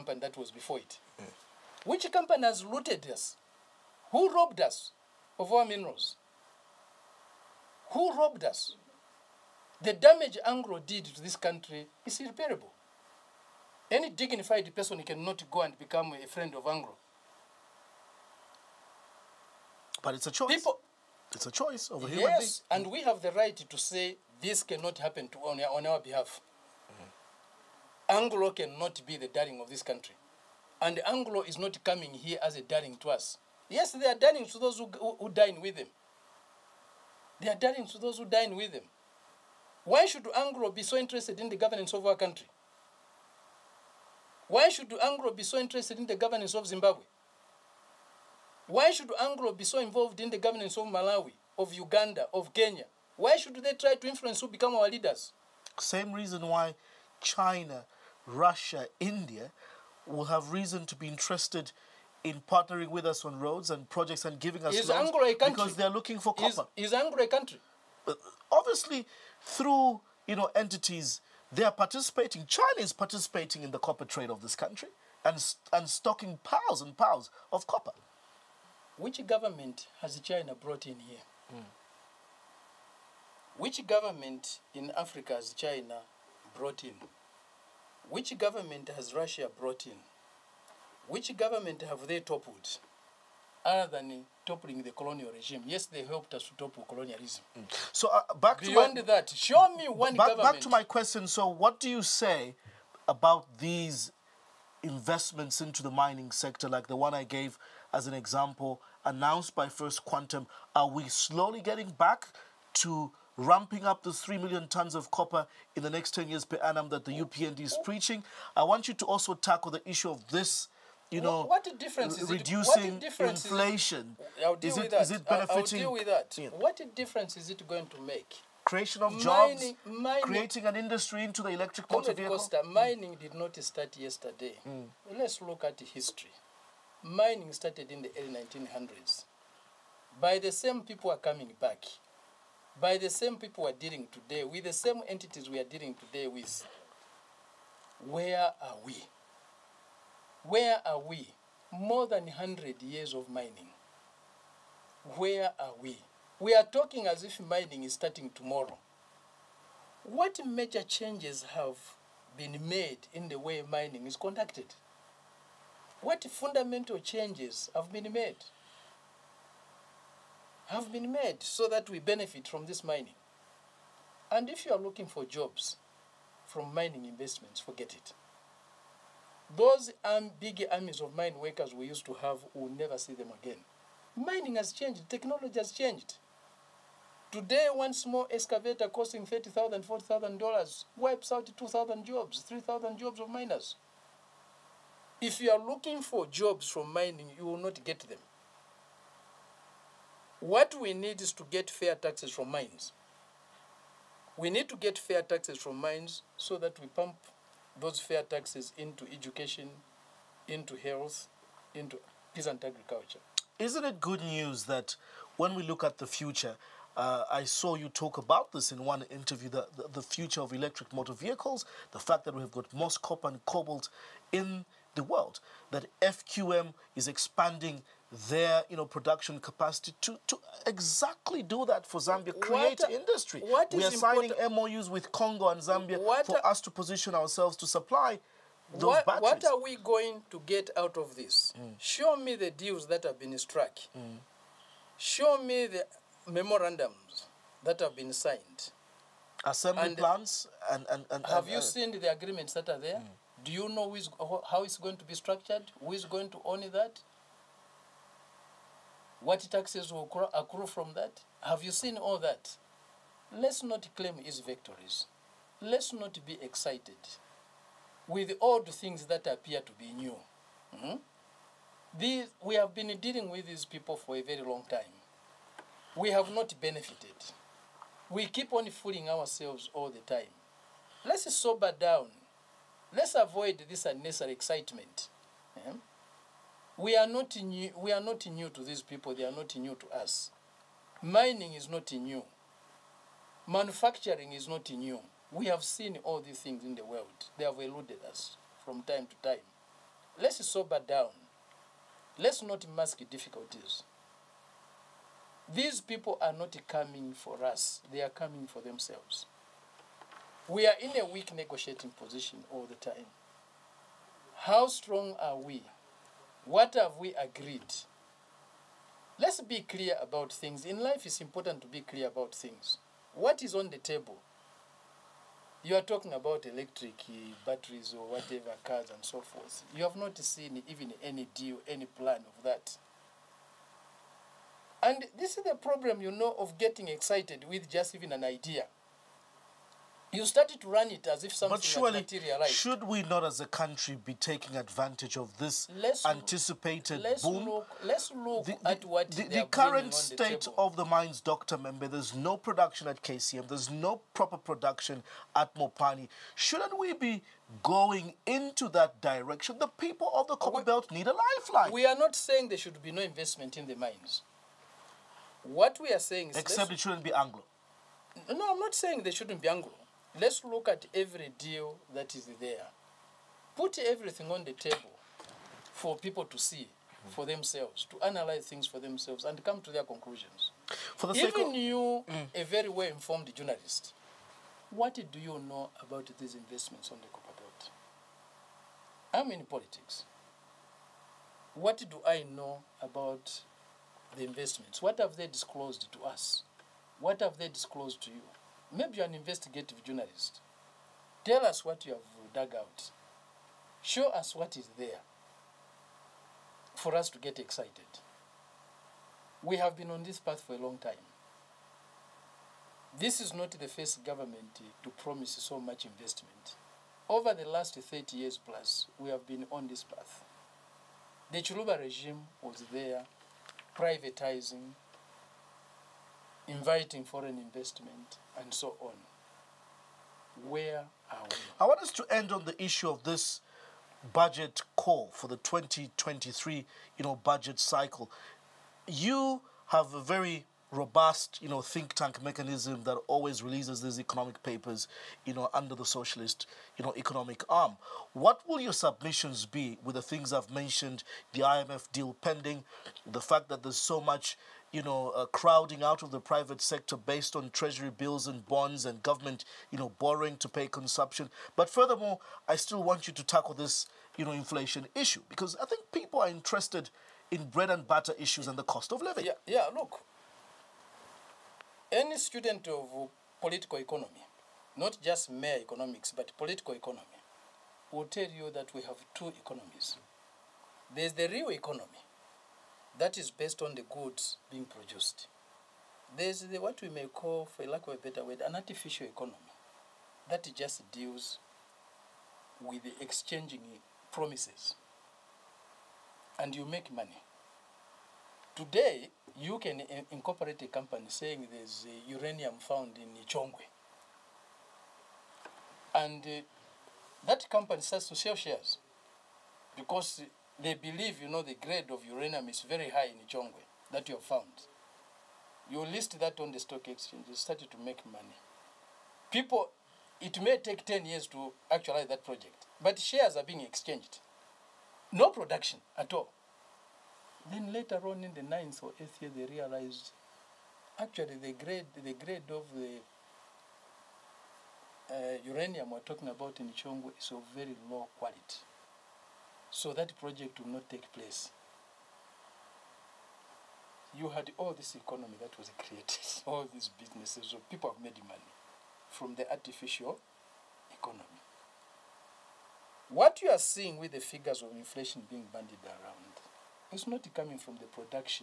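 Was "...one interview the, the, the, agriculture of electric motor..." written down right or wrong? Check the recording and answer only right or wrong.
wrong.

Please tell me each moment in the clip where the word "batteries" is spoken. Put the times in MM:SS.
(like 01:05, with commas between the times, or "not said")
03:59, 05:27.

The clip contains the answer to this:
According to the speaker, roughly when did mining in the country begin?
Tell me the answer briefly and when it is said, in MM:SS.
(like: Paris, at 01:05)
early 1900s, at 02:18.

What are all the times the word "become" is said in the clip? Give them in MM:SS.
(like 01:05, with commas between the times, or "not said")
00:15, 00:54.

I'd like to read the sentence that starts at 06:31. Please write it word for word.
What do I know about the investments?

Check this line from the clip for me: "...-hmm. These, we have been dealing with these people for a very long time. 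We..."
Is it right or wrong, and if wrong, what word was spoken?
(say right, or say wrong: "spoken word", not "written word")
right.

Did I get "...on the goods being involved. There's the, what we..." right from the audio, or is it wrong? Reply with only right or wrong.
wrong.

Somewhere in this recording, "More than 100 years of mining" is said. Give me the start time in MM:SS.
02:31.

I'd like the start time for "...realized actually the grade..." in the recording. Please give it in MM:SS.
08:49.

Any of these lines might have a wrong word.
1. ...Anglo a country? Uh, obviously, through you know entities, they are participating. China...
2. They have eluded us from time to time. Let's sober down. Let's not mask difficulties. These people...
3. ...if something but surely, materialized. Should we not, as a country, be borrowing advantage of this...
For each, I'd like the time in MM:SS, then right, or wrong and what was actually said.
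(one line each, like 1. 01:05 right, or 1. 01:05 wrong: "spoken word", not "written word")
1. 01:06 right
2. 04:57 right
3. 05:41 wrong: "taking", not "borrowing".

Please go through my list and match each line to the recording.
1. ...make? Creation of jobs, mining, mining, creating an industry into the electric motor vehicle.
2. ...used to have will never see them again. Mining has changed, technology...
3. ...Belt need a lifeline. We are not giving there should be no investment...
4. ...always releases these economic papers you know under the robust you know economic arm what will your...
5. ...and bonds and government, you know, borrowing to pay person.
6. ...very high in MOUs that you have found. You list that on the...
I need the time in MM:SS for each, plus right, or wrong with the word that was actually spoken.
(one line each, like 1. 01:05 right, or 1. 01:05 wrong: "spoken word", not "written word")
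1. 02:08 right
2. 03:01 right
3. 06:00 wrong: "saying", not "giving"
4. 07:23 wrong: "socialist", not "robust"
5. 07:38 wrong: "consumption", not "person"
6. 08:32 wrong: "Chongwe", not "MOUs".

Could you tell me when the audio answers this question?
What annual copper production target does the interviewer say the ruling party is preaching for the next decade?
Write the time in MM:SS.
01:54.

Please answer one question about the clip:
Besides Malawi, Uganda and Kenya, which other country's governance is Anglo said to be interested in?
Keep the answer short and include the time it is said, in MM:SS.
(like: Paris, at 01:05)
Zimbabwe, at 00:46.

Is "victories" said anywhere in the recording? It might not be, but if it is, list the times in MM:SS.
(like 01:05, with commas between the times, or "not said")
04:24.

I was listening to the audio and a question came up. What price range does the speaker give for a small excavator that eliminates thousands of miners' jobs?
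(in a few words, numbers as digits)
$30,000 to $40,000.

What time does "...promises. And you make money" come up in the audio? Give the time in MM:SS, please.
08:14.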